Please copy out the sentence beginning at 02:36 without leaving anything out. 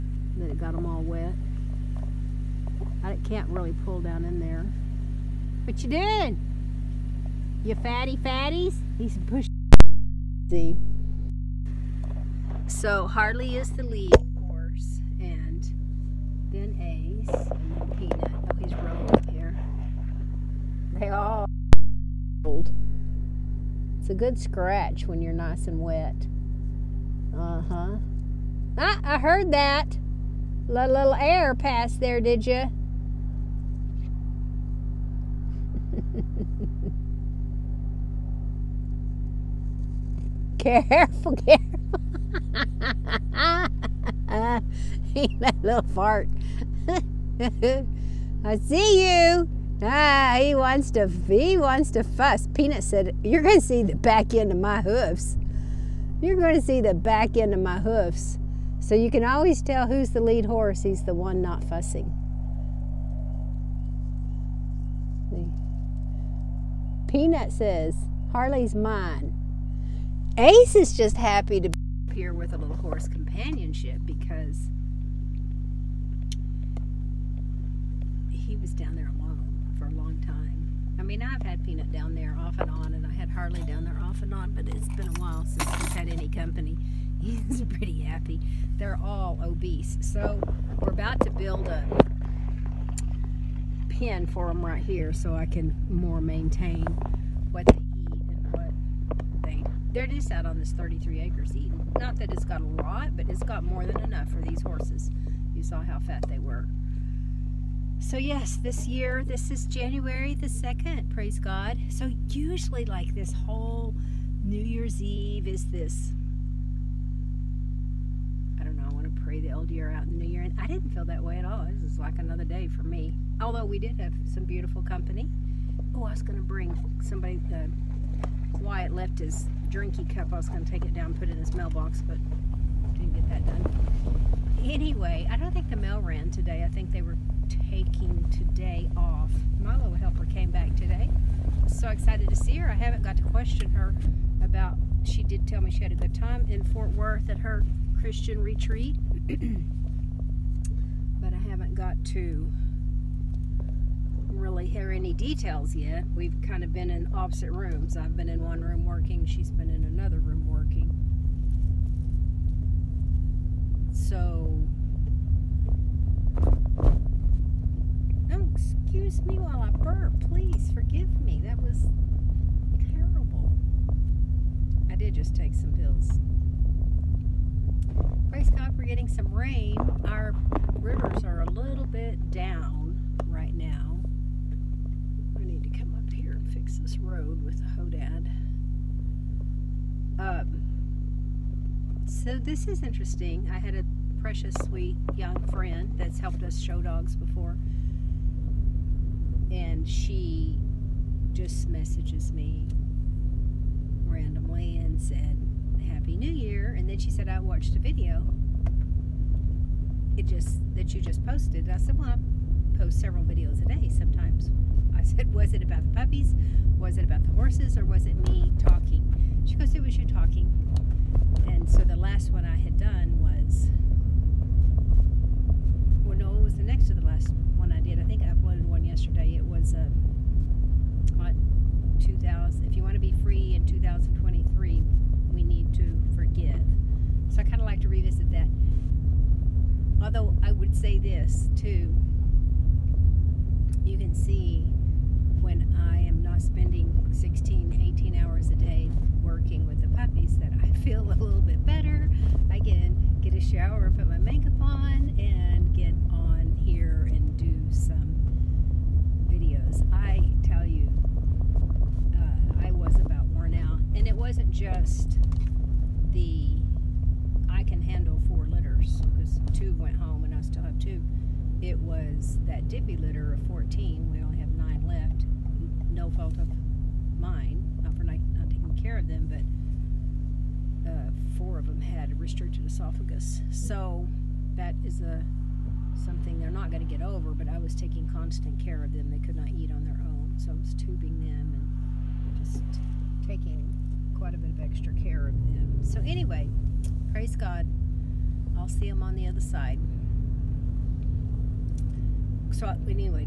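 We've kind of been in opposite rooms.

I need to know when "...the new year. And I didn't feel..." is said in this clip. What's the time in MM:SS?
02:00.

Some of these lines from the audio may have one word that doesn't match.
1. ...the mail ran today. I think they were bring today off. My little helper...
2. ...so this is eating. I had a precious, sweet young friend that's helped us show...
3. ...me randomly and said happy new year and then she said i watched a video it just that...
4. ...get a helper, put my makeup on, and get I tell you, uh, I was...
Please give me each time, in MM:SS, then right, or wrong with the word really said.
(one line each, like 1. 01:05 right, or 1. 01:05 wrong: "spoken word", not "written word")
1. 02:15 wrong: "taking", not "bring"
2. 03:12 wrong: "interesting", not "eating"
3. 03:22 right
4. 04:13 wrong: "shower", not "helper".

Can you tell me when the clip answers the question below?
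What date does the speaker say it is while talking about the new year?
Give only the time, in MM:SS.
01:49.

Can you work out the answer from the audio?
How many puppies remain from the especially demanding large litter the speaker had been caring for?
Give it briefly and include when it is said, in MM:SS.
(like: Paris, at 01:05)
9, at 04:34.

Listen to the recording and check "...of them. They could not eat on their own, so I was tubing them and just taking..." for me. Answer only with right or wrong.
right.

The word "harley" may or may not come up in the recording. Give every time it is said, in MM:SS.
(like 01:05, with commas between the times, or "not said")
00:13, 01:08, 01:23.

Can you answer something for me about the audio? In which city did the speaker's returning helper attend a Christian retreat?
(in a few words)
Fort Worth.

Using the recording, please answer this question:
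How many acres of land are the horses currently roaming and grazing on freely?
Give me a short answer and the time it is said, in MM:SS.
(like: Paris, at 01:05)
33, at 01:40.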